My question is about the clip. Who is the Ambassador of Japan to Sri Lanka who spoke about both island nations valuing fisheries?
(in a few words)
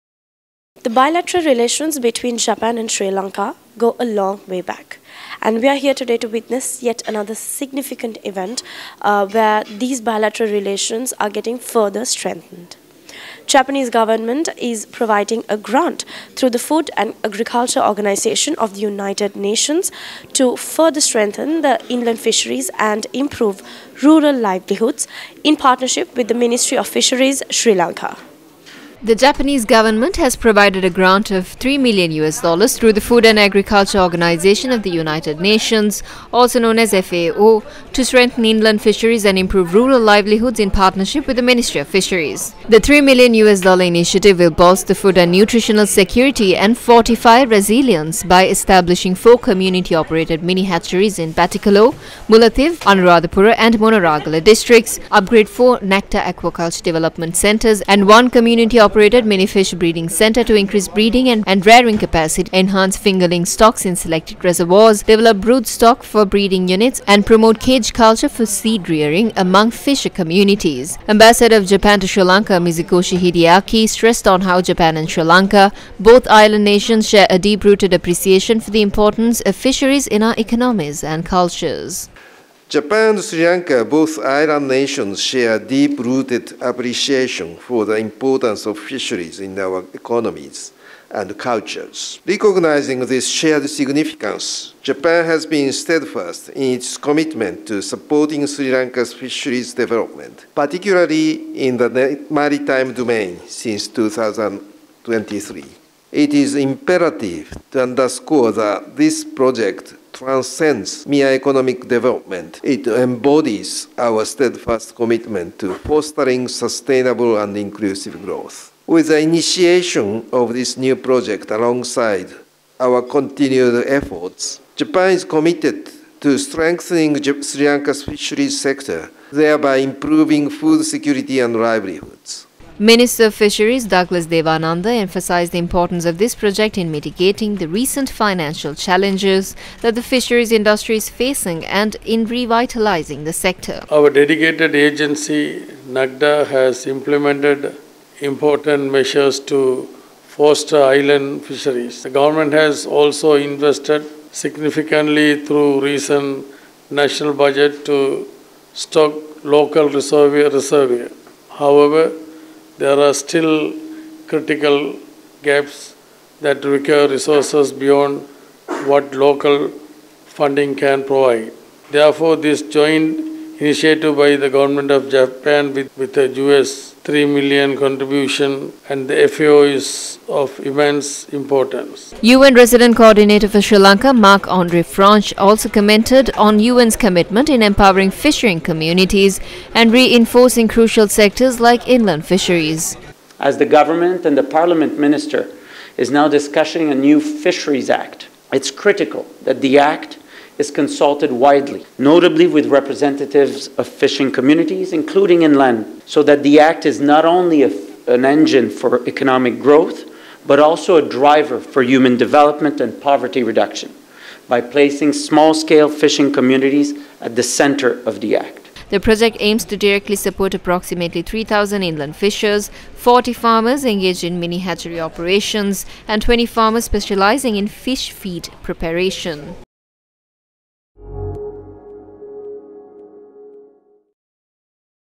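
Mizukoshi Hideaki.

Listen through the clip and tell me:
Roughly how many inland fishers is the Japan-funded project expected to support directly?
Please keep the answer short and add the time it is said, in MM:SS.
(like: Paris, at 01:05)
3,000, at 03:41.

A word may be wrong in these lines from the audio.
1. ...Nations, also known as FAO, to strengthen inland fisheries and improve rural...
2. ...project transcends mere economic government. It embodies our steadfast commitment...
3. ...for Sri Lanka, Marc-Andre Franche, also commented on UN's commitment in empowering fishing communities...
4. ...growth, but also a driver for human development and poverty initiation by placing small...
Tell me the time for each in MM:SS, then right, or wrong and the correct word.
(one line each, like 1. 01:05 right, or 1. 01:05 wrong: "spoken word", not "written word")
1. 00:35 right
2. 01:49 wrong: "development", not "government"
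3. 03:03 right
4. 03:29 wrong: "reduction", not "initiation".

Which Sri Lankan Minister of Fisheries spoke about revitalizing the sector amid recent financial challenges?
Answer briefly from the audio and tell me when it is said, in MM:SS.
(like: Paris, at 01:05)
Douglas Devananda, at 02:13.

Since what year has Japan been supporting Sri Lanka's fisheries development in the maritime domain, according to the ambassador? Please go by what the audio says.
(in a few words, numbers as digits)
2023.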